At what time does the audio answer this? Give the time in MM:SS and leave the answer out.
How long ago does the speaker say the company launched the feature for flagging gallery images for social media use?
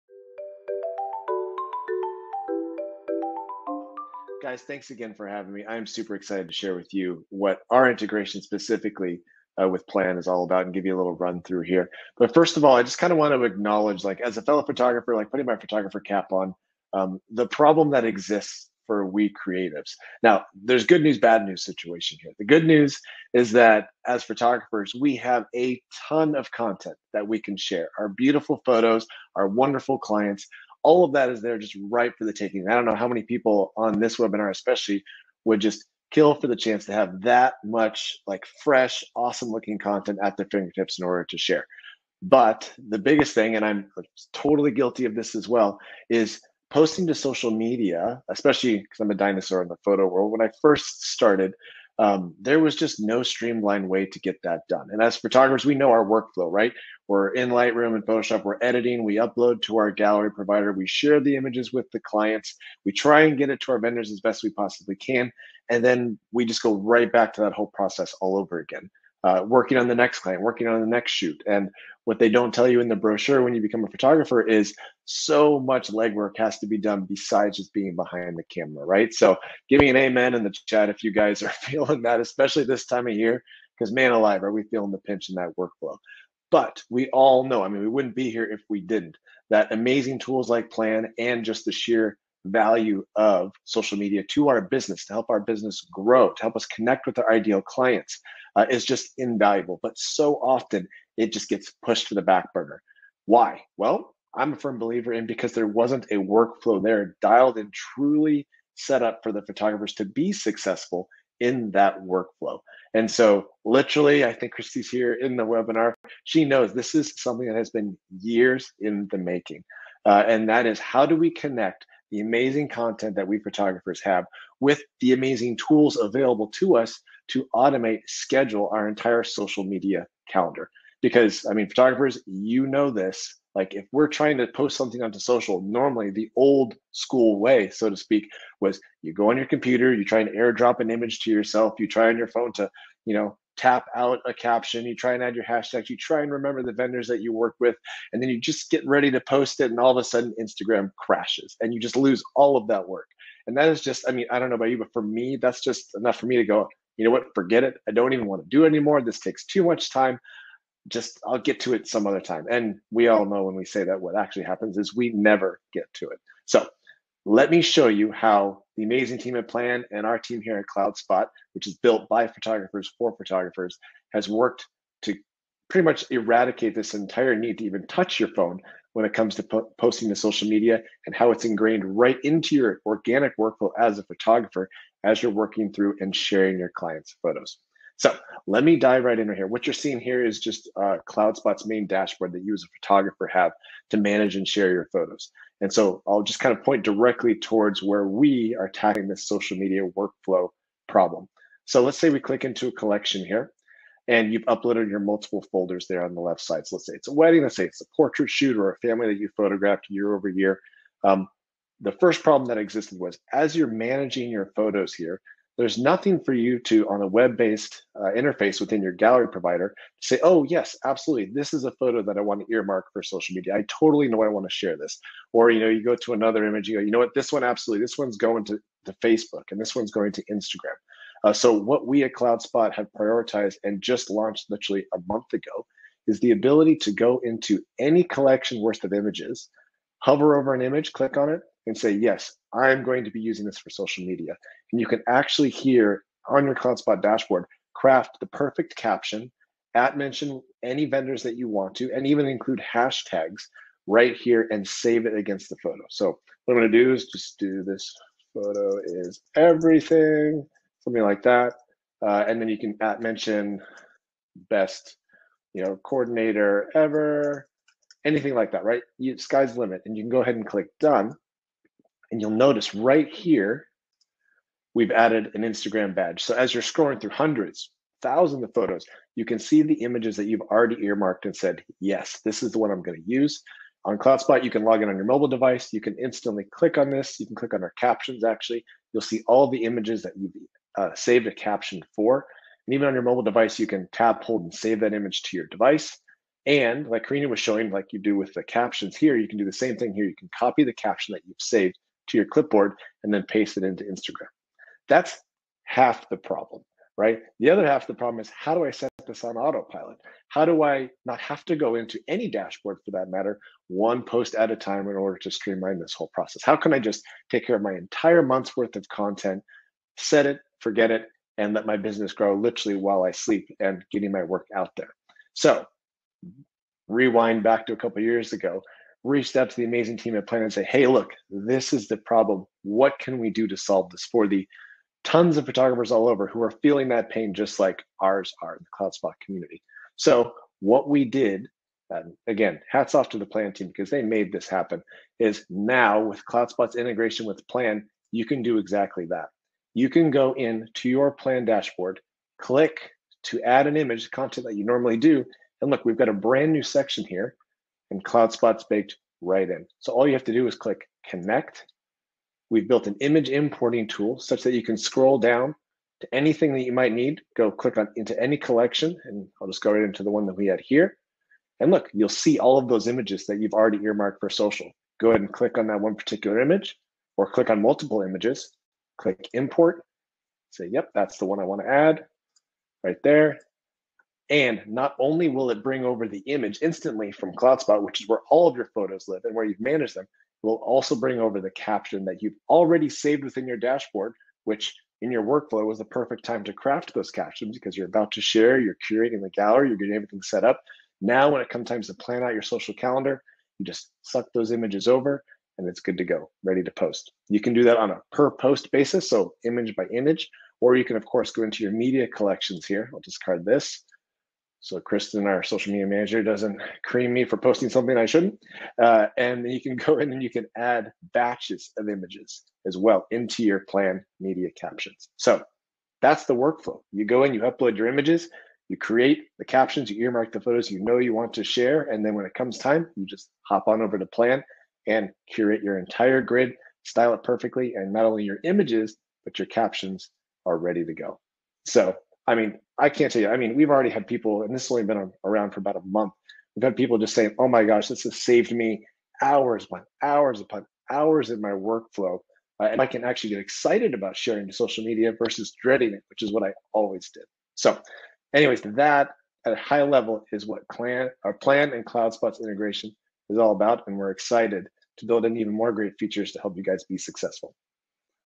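03:54.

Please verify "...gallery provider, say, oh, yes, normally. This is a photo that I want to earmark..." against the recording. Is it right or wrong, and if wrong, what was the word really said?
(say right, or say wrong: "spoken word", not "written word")
wrong: "absolutely", not "normally".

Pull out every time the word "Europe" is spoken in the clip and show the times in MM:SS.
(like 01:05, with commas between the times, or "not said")
not said.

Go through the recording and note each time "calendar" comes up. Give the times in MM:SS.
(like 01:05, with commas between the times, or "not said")
02:10, 06:42.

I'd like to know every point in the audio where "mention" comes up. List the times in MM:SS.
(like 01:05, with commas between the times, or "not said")
04:09, 04:23.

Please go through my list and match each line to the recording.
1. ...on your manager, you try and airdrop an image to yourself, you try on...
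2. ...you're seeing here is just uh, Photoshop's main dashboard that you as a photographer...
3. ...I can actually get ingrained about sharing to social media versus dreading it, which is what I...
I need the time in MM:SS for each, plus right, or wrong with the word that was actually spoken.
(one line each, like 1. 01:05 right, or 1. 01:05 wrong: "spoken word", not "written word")
1. 02:19 wrong: "computer", not "manager"
2. 03:09 wrong: "CloudSpot", not "Photoshop"
3. 07:32 wrong: "excited", not "ingrained".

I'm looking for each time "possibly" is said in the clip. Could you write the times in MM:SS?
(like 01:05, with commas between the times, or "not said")
01:04.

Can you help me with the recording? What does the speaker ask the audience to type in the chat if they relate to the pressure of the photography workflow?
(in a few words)
amen.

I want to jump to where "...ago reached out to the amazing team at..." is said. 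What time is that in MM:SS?
05:28.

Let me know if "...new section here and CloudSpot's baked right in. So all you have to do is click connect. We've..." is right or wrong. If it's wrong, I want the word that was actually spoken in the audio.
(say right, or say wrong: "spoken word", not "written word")
right.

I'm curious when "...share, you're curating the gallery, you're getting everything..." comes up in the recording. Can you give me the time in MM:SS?
06:38.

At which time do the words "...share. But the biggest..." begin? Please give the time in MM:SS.
00:41.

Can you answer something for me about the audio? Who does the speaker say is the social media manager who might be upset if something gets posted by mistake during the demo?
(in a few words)
Kristen.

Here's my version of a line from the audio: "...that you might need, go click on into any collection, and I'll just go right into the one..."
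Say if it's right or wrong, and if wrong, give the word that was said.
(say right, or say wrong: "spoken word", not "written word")
right.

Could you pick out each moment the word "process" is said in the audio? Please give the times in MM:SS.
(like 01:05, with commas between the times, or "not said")
01:07, 05:16.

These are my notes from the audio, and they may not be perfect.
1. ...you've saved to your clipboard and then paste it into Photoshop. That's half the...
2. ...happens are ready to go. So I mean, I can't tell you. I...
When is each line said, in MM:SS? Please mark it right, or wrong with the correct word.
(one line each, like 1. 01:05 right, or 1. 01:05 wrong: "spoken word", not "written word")
1. 05:01 wrong: "Instagram", not "Photoshop"
2. 07:19 wrong: "captions", not "happens".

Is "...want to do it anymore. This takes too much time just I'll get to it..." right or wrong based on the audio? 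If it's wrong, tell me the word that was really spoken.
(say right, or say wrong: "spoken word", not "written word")
right.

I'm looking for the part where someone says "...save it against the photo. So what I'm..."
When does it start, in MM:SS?
04:14.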